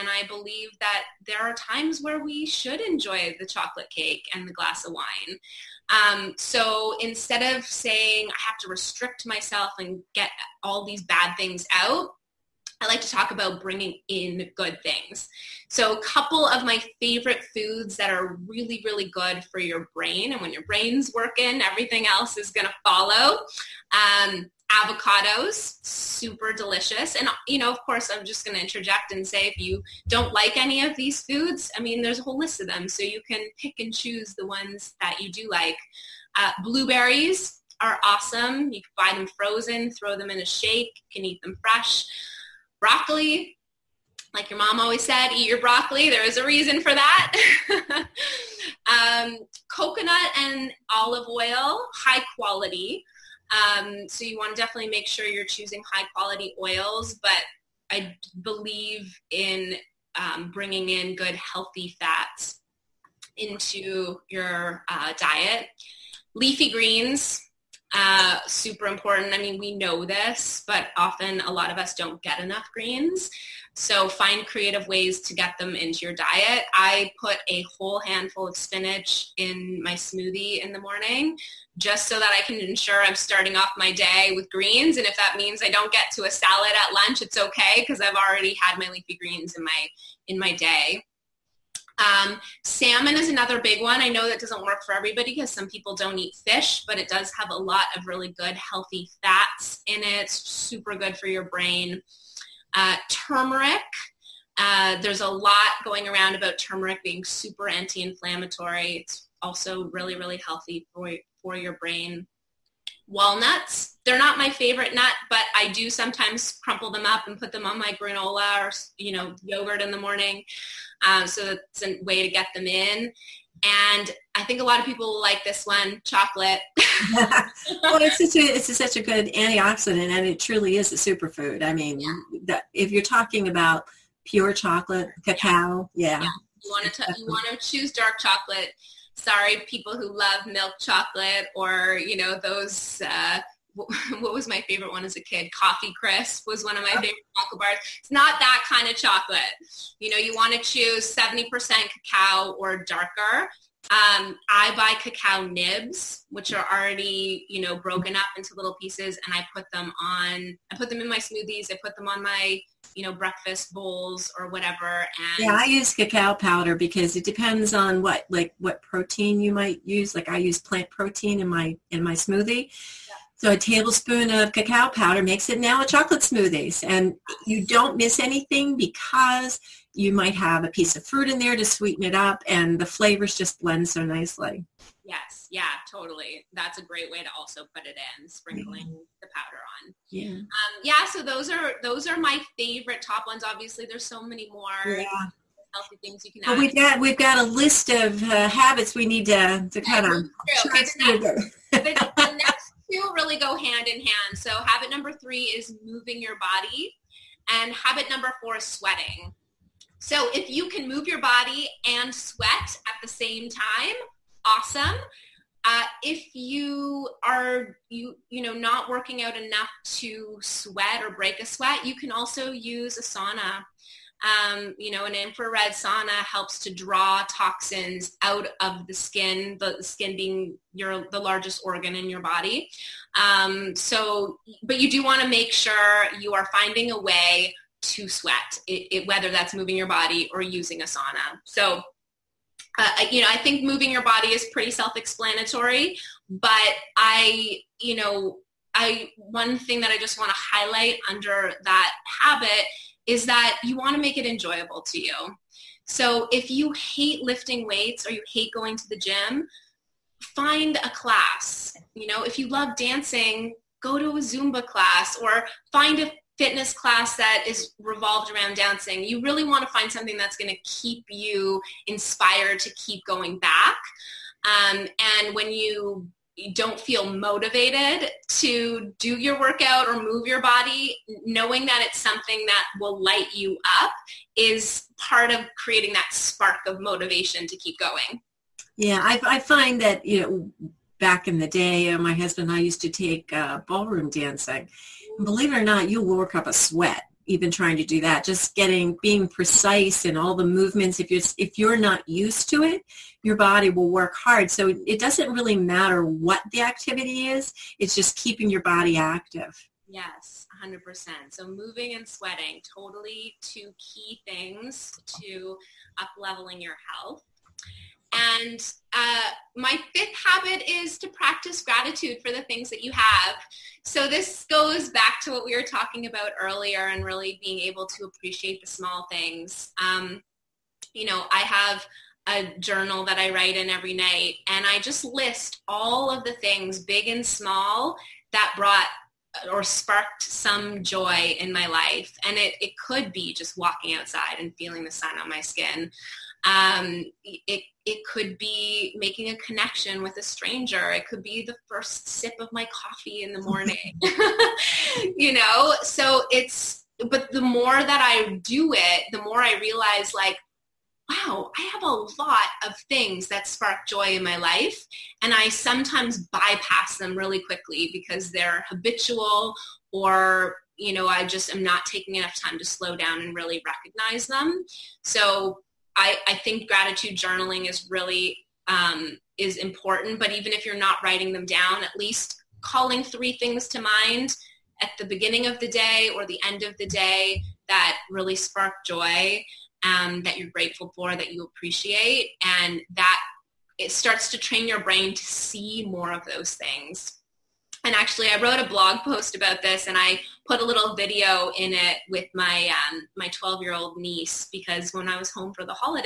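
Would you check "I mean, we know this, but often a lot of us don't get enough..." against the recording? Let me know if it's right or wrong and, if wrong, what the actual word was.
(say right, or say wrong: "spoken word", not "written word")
right.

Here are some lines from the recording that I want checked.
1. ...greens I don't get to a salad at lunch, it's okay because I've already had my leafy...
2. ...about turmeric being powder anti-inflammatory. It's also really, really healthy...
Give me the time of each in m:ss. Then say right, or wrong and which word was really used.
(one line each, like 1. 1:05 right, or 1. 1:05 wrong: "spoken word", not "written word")
1. 1:25 wrong: "means", not "greens"
2. 1:46 wrong: "super", not "powder".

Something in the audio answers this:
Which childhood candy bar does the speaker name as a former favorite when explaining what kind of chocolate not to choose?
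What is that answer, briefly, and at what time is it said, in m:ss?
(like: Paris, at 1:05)
Coffee Crisp, at 2:25.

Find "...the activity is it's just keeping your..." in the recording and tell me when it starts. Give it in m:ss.
5:06.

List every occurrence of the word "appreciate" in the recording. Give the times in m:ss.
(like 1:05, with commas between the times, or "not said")
5:28, 6:31.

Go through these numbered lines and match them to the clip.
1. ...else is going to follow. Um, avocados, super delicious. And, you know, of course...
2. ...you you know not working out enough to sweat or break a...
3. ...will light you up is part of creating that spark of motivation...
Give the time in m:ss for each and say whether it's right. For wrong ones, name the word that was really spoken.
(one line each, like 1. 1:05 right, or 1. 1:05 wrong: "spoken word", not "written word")
1. 0:22 right
2. 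3:37 right
3. 4:42 right.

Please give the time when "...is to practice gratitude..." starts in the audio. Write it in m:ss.
5:20.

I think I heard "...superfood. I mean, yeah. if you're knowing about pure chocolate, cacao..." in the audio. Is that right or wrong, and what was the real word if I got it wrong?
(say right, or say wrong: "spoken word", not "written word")
wrong: "talking", not "knowing".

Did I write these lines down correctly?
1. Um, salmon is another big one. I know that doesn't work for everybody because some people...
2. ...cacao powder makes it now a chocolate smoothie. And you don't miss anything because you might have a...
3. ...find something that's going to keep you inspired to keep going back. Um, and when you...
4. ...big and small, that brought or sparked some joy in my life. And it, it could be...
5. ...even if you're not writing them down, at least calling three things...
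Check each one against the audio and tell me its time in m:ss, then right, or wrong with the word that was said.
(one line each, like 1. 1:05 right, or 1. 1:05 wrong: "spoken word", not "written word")
1. 1:31 right
2. 2:54 right
3. 4:29 right
4. 5:36 right
5. 6:20 right.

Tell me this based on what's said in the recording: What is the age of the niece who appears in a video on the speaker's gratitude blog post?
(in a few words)
12.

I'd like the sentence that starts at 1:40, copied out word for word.
super good for your brain uh, turmeric.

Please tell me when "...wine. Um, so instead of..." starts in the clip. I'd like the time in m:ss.
0:04.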